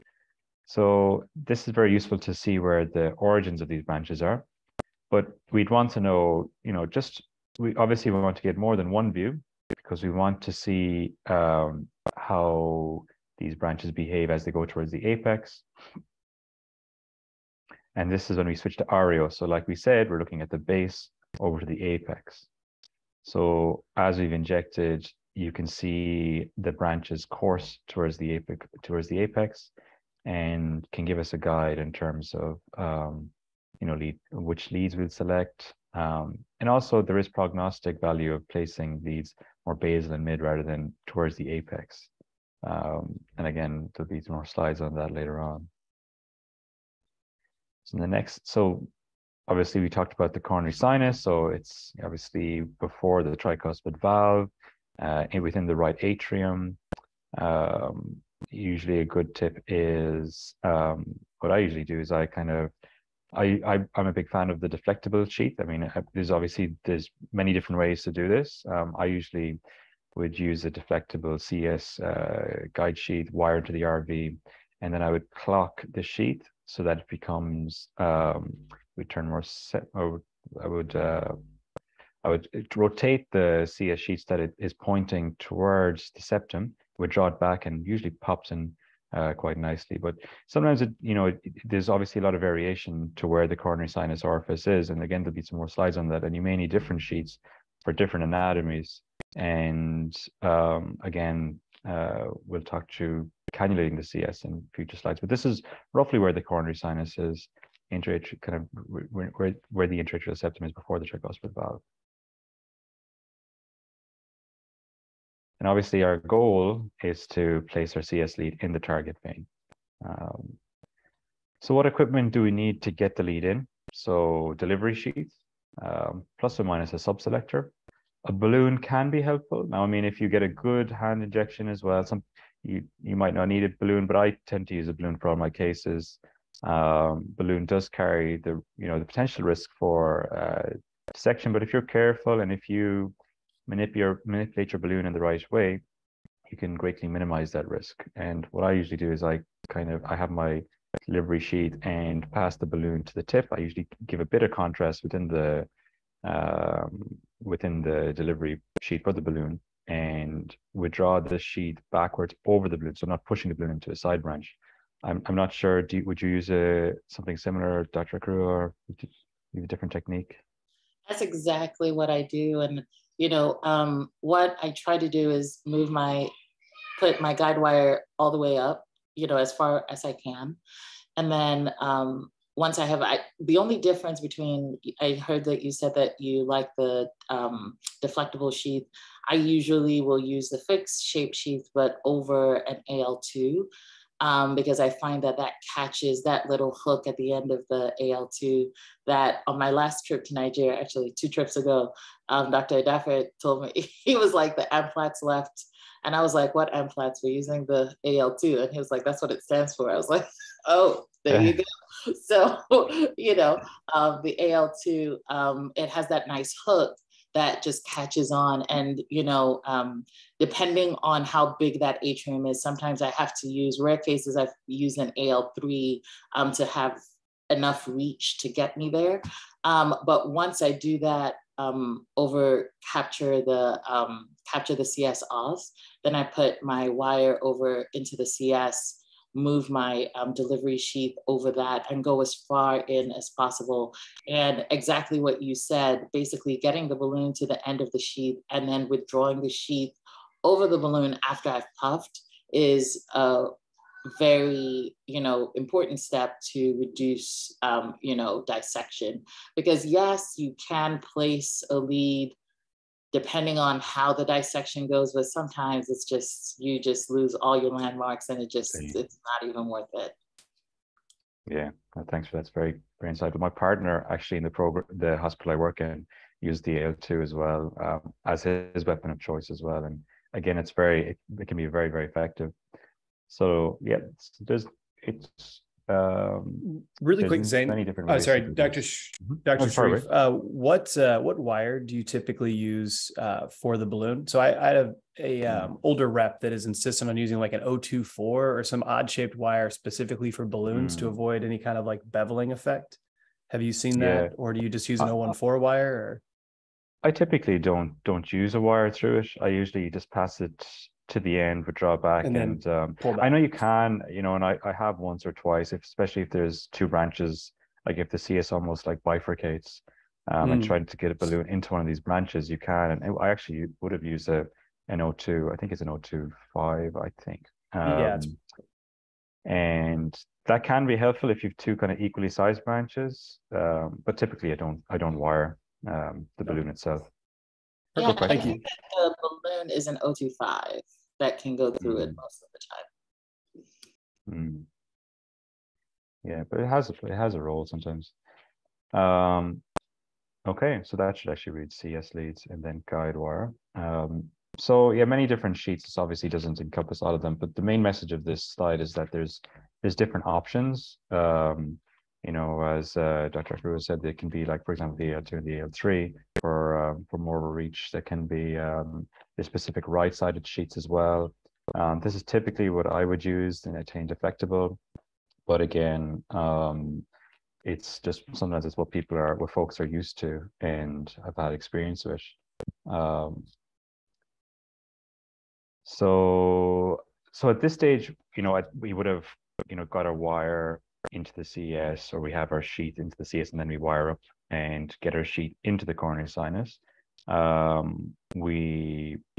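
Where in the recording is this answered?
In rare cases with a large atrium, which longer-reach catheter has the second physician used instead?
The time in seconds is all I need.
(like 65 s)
225 s.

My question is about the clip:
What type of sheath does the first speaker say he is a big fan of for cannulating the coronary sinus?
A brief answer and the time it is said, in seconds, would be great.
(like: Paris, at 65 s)
deflectable sheath, at 64 s.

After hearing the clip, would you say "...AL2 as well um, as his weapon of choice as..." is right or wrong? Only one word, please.
right.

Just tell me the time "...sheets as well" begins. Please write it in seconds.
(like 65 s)
370 s.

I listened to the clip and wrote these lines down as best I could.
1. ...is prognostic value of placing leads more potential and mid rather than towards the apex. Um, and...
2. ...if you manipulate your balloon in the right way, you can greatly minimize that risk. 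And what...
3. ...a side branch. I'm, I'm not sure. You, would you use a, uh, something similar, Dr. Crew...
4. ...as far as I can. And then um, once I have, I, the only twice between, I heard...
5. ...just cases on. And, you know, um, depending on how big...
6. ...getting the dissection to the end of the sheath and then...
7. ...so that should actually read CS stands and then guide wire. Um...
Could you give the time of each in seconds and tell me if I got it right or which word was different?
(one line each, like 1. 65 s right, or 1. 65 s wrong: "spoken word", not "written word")
1. 37 s wrong: "basal", not "potential"
2. 142 s right
3. 163 s right
4. 179 s wrong: "difference", not "twice"
5. 217 s wrong: "catches", not "cases"
6. 246 s wrong: "balloon", not "dissection"
7. 350 s wrong: "leads", not "stands".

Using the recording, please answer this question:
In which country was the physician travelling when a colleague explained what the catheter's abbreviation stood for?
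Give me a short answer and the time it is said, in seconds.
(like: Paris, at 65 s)
Nigeria, at 200 s.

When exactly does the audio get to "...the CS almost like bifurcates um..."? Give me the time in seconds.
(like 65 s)
318 s.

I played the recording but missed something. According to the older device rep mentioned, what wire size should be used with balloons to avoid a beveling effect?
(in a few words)
024.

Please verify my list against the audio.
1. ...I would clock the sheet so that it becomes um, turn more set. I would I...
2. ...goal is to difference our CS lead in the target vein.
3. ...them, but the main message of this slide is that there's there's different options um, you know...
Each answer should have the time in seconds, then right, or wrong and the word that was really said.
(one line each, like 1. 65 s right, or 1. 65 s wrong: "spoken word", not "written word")
1. 75 s right
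2. 116 s wrong: "place", not "difference"
3. 357 s right.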